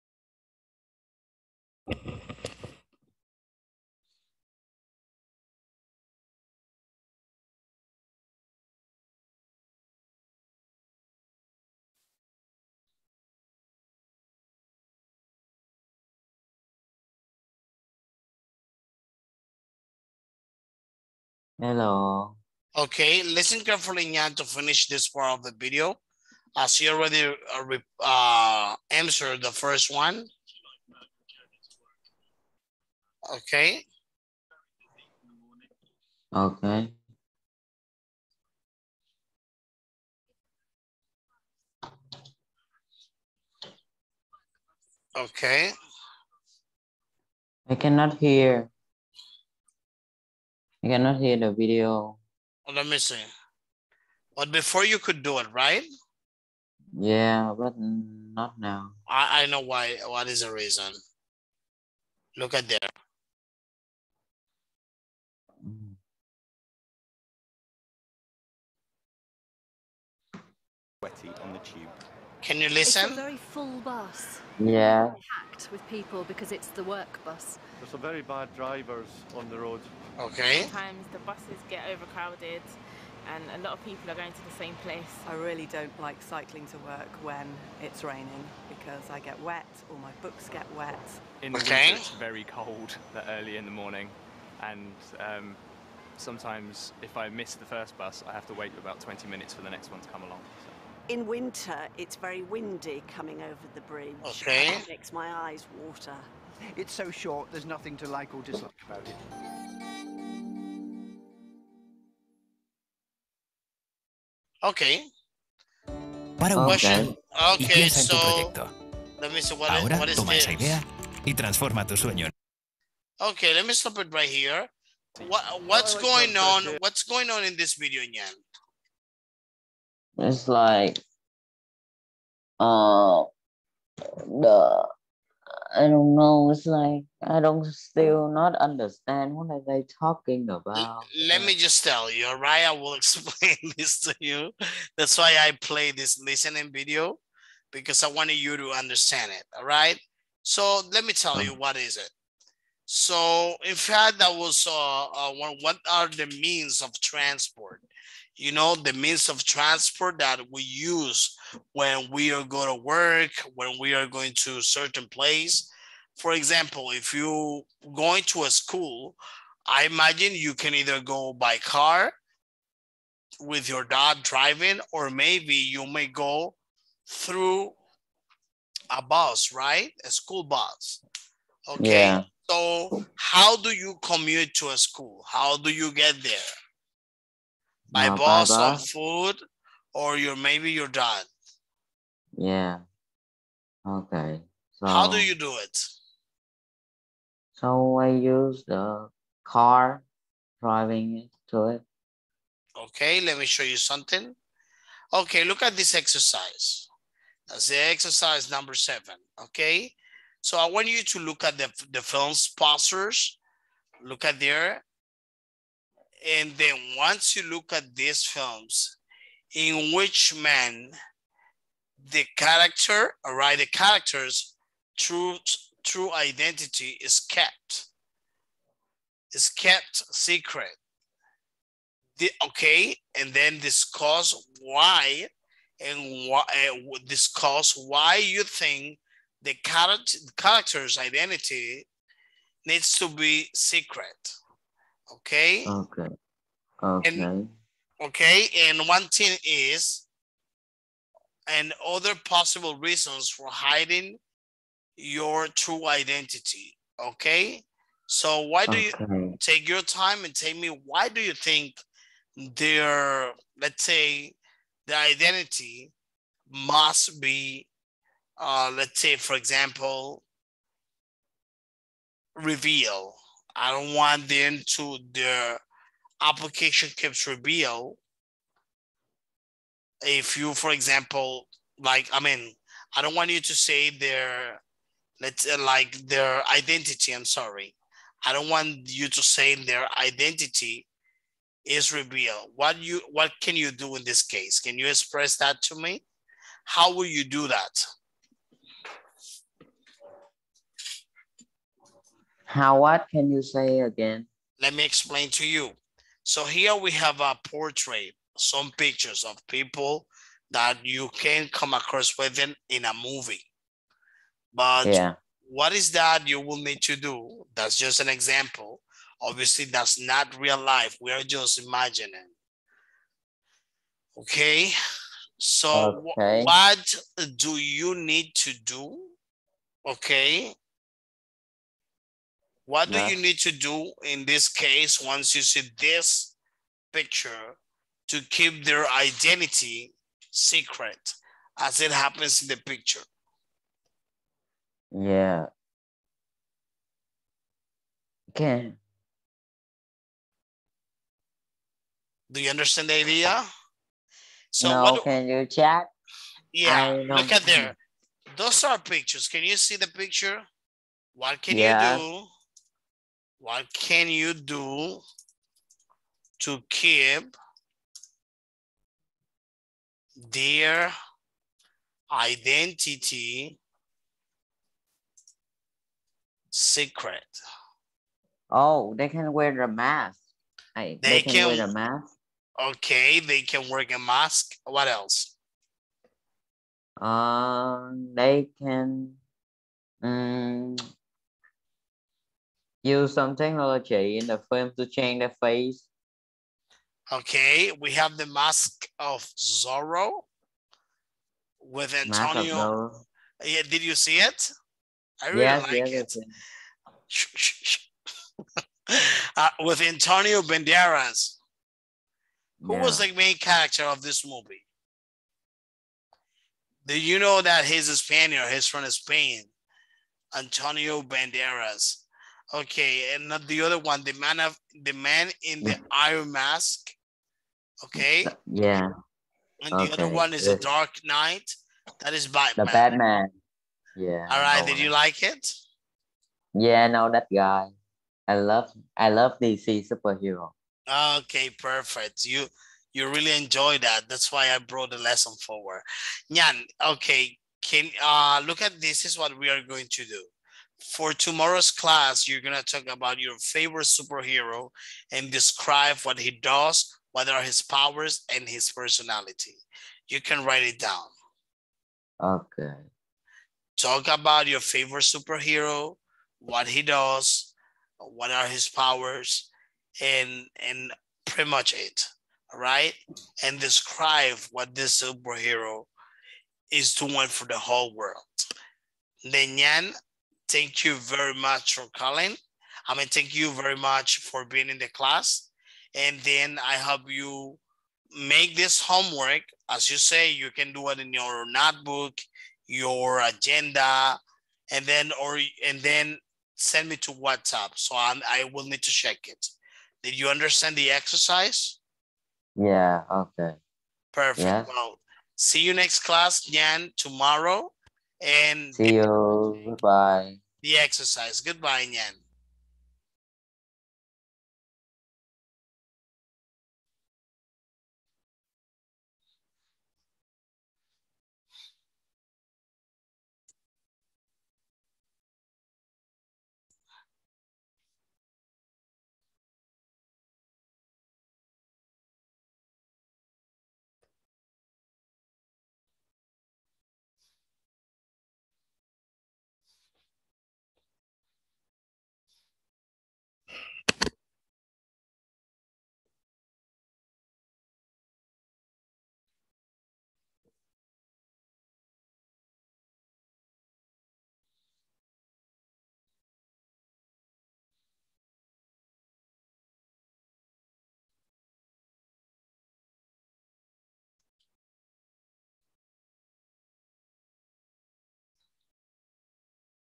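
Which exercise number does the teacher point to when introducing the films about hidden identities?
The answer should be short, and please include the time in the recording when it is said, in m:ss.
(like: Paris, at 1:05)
7, at 3:28.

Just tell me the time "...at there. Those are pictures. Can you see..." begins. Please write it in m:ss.
5:57.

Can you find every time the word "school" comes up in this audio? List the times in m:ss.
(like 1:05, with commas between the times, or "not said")
2:48, 3:00, 3:04.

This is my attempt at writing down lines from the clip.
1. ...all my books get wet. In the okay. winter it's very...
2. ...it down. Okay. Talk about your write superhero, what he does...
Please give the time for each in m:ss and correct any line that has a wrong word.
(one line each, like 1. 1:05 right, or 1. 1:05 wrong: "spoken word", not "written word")
1. 1:29 right
2. 7:40 wrong: "favorite", not "write".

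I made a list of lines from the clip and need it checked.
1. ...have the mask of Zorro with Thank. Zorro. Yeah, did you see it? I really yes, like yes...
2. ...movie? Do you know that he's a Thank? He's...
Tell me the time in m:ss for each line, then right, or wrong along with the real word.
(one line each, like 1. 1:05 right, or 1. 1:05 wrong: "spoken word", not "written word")
1. 6:37 wrong: "Antonio", not "Thank"
2. 6:54 wrong: "Spaniard", not "Thank".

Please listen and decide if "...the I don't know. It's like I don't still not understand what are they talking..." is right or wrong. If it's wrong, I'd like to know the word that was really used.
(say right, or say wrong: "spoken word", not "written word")
right.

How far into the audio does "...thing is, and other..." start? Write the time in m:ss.
4:09.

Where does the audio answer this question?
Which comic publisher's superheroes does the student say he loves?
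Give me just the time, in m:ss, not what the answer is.
7:19.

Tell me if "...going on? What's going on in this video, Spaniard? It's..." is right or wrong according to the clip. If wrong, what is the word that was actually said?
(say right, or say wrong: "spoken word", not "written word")
wrong: "Yan", not "Spaniard".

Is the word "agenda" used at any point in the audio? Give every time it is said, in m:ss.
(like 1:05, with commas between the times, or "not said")
8:13.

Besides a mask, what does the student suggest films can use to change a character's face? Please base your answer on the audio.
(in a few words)
technology.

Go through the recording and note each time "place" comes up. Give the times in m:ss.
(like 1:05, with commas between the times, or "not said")
1:24, 2:45.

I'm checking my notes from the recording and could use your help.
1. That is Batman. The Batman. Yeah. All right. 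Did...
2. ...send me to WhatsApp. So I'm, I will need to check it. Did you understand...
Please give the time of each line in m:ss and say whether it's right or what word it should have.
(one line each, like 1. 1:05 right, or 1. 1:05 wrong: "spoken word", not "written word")
1. 7:12 right
2. 8:16 right.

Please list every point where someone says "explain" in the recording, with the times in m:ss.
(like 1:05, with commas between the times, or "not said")
2:22, 5:04.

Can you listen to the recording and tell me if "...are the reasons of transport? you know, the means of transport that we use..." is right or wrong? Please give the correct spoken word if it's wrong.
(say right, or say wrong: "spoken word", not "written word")
wrong: "means", not "reasons".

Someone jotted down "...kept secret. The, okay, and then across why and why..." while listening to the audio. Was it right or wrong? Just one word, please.
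wrong.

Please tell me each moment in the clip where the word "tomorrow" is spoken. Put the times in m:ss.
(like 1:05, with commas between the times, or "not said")
7:31, 8:26.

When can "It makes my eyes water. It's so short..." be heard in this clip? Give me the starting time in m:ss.
1:44.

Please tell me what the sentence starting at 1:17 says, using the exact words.
There's some very bad drivers on the road.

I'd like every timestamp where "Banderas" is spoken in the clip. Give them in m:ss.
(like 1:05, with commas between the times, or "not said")
6:50, 7:01.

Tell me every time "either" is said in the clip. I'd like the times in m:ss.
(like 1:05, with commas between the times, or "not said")
2:50.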